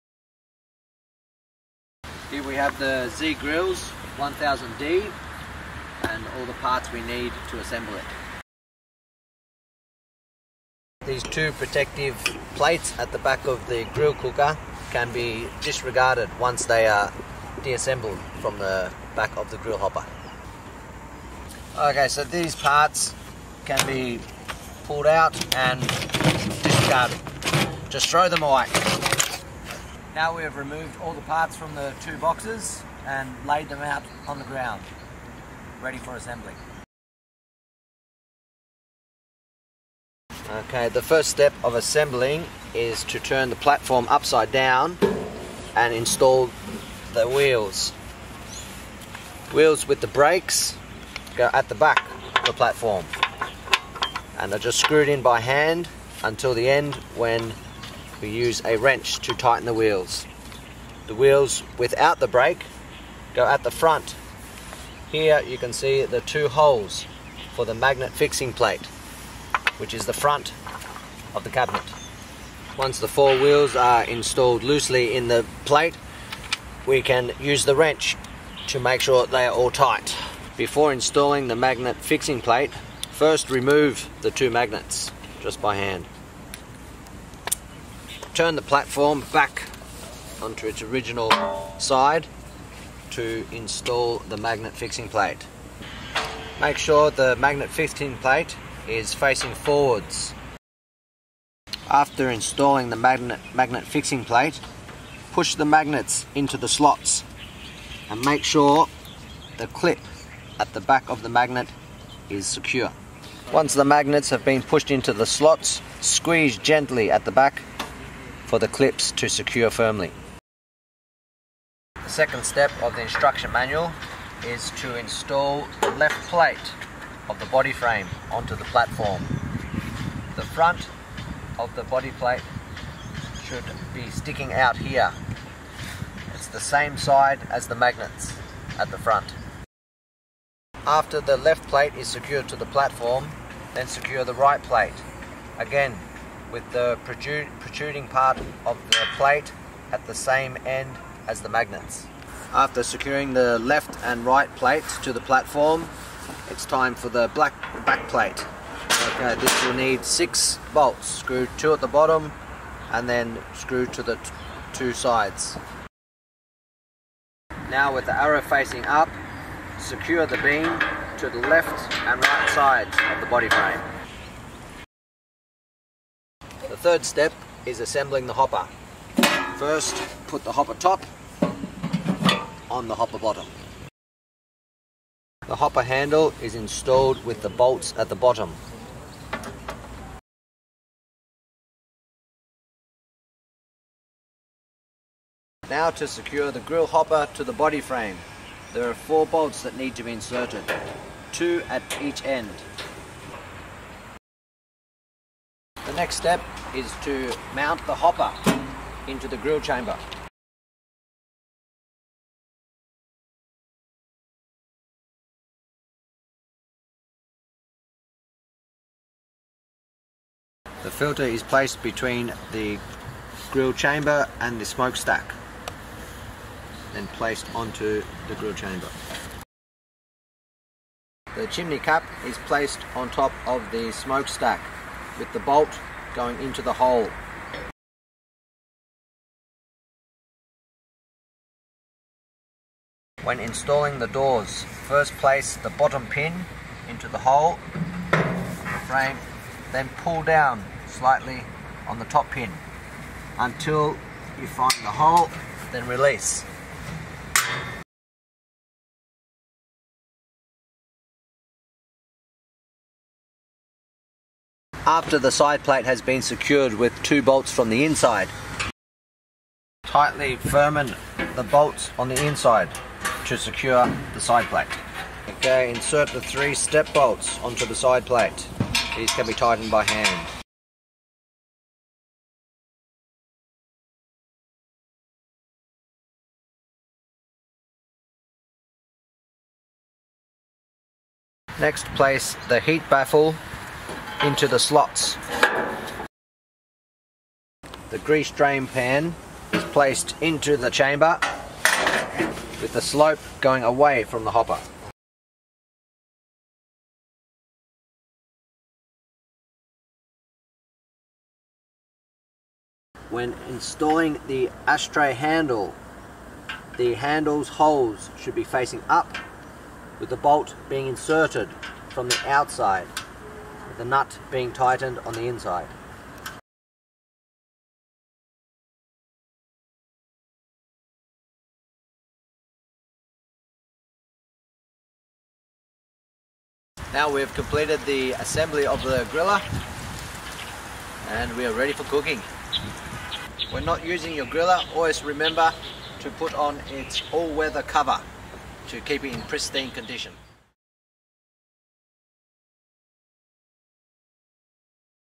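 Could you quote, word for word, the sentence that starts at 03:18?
There are four bolts that need to be inserted, two at each end.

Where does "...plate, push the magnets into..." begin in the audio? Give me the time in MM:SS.
01:44.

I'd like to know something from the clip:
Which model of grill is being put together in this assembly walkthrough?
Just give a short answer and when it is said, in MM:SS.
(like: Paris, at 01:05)
Z Grills 1000D, at 00:03.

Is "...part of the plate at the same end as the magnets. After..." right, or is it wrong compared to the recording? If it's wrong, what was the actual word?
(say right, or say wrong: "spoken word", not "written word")
right.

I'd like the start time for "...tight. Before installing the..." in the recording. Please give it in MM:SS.
01:19.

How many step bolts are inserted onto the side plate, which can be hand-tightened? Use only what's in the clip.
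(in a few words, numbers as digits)
3.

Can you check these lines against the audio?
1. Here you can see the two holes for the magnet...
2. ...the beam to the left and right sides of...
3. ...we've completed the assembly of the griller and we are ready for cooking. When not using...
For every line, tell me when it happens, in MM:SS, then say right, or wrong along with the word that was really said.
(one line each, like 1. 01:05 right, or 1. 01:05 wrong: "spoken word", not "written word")
1. 01:05 right
2. 02:50 right
3. 05:37 right.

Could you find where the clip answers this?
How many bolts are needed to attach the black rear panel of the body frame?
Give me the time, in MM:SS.
02:40.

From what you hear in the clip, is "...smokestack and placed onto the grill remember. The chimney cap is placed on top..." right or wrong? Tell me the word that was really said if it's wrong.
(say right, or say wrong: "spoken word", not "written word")
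wrong: "chamber", not "remember".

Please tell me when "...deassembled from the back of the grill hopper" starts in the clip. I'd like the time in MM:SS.
00:17.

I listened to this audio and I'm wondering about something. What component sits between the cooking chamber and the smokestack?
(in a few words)
filter.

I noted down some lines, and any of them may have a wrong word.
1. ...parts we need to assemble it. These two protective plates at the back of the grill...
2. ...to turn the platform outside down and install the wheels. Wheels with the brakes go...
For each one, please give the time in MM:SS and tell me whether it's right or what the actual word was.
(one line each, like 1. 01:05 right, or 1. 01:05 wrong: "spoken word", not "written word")
1. 00:06 right
2. 00:43 wrong: "upside", not "outside".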